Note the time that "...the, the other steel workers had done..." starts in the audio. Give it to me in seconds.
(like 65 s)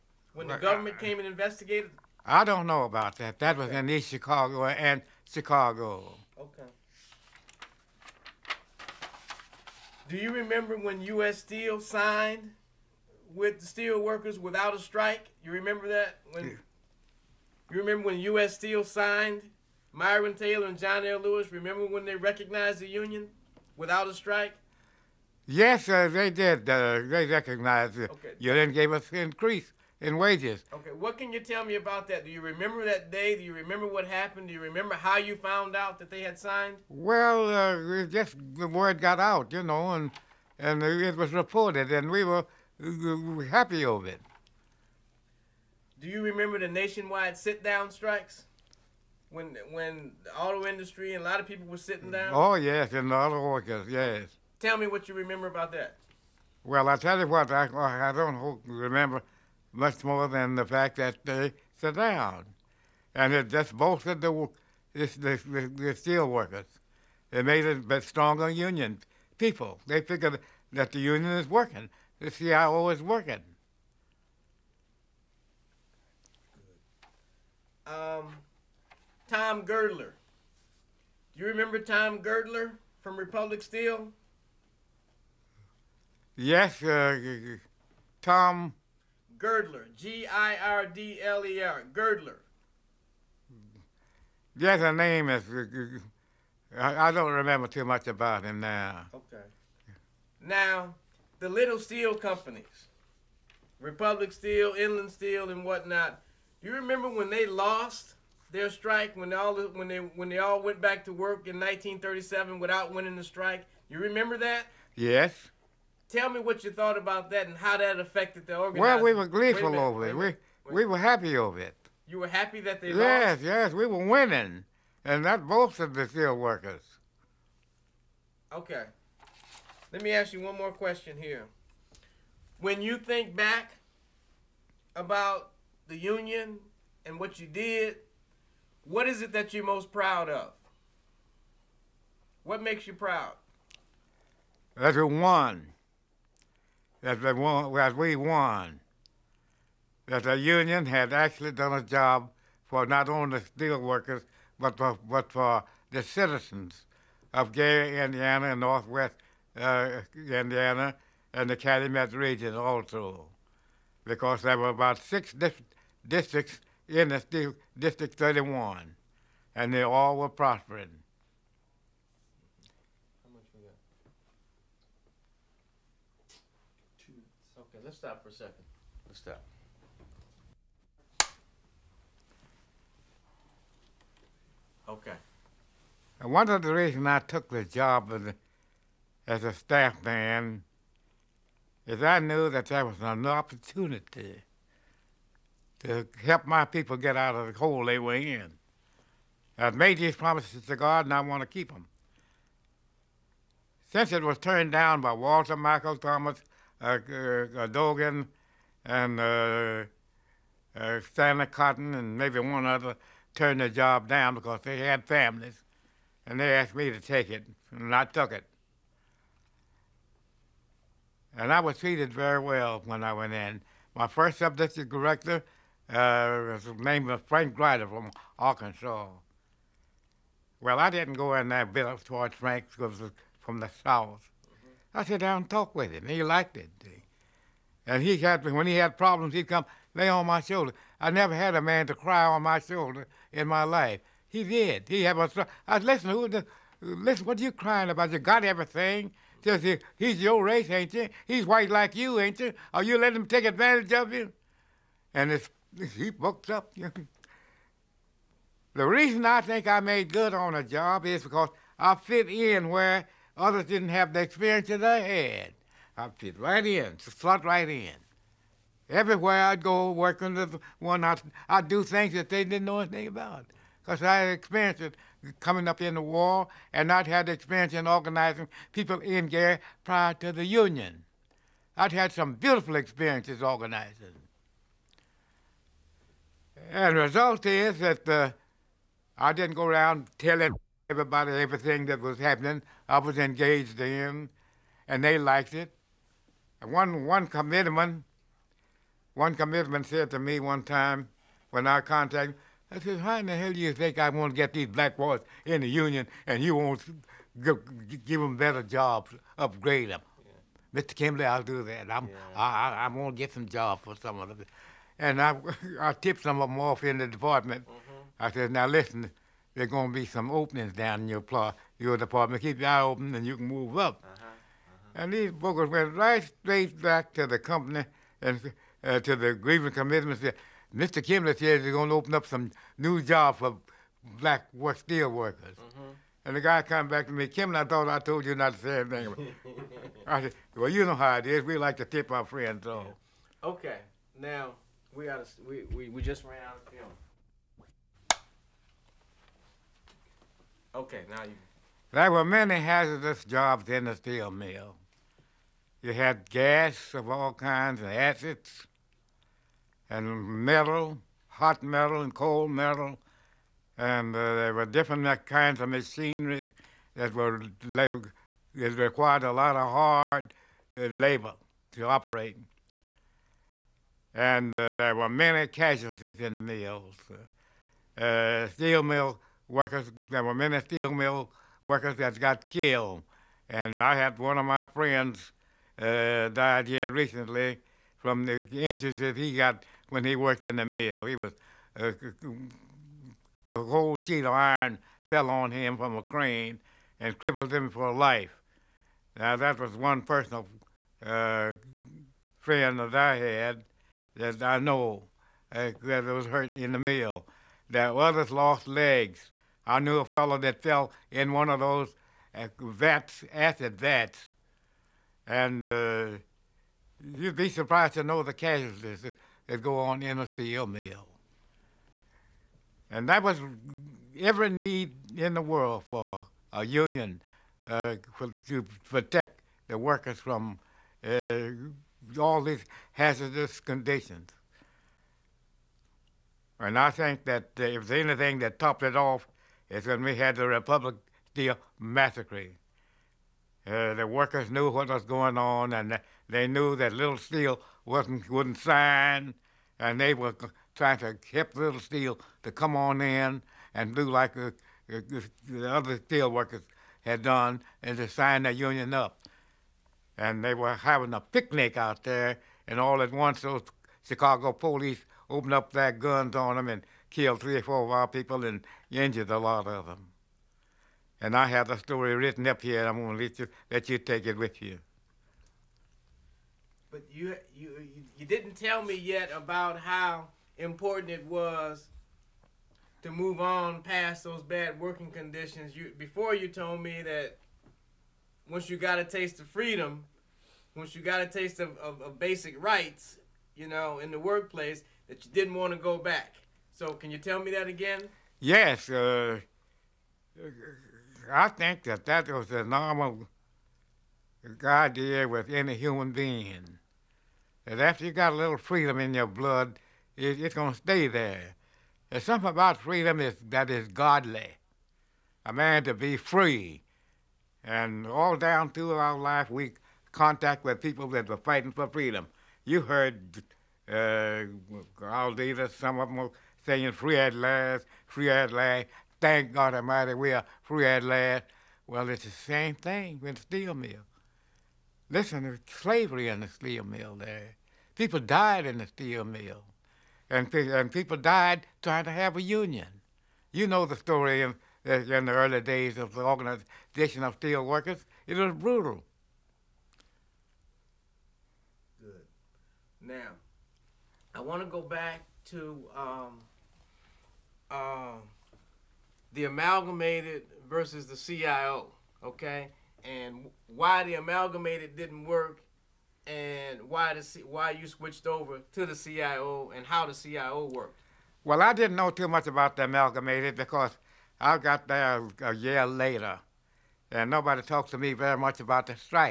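454 s.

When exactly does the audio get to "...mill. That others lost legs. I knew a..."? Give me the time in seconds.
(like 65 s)
406 s.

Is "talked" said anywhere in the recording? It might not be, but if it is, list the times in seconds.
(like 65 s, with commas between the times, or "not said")
235 s, 577 s.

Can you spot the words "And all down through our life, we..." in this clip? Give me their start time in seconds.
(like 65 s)
517 s.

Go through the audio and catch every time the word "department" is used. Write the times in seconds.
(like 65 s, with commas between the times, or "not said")
317 s, 321 s.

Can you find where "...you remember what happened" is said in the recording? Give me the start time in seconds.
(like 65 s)
33 s.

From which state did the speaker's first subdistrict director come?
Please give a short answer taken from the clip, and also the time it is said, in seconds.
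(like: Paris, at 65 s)
Arkansas, at 228 s.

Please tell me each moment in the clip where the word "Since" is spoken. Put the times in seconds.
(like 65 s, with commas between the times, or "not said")
203 s.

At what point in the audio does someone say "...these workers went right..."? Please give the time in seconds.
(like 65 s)
325 s.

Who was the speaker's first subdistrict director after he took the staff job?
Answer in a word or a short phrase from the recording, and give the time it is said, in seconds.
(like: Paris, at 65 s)
Frank Grider, at 227 s.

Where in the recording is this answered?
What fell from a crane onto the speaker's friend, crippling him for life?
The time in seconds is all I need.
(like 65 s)
393 s.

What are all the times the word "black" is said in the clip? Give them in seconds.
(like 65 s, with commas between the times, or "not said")
304 s, 334 s.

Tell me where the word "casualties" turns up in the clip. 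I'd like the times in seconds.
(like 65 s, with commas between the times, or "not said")
375 s, 418 s.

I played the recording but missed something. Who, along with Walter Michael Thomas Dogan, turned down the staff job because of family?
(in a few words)
Stanley Cotton.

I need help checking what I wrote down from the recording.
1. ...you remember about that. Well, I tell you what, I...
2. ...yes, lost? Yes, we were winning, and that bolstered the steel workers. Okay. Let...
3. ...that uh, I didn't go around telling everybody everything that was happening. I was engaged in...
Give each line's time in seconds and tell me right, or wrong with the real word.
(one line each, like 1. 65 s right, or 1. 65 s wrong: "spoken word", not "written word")
1. 55 s right
2. 122 s right
3. 287 s right.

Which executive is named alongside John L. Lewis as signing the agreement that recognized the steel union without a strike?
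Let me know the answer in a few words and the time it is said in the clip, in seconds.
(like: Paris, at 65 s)
Myron Taylor, at 19 s.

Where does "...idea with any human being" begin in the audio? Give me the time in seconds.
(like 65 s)
504 s.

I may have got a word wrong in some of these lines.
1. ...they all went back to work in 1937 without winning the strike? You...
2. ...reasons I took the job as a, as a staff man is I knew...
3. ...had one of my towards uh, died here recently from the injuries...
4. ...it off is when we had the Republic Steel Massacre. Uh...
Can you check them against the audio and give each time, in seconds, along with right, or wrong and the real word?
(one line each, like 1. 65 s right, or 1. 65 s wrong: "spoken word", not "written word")
1. 110 s right
2. 186 s right
3. 383 s wrong: "friends", not "towards"
4. 438 s right.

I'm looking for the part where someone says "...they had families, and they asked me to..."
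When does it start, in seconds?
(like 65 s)
214 s.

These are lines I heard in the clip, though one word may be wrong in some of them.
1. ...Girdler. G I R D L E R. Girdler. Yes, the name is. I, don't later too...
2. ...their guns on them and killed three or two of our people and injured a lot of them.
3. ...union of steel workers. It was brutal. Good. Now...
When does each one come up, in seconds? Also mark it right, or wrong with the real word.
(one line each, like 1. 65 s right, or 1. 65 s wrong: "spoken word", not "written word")
1. 89 s wrong: "remember", not "later"
2. 465 s wrong: "four", not "two"
3. 546 s wrong: "organization", not "union".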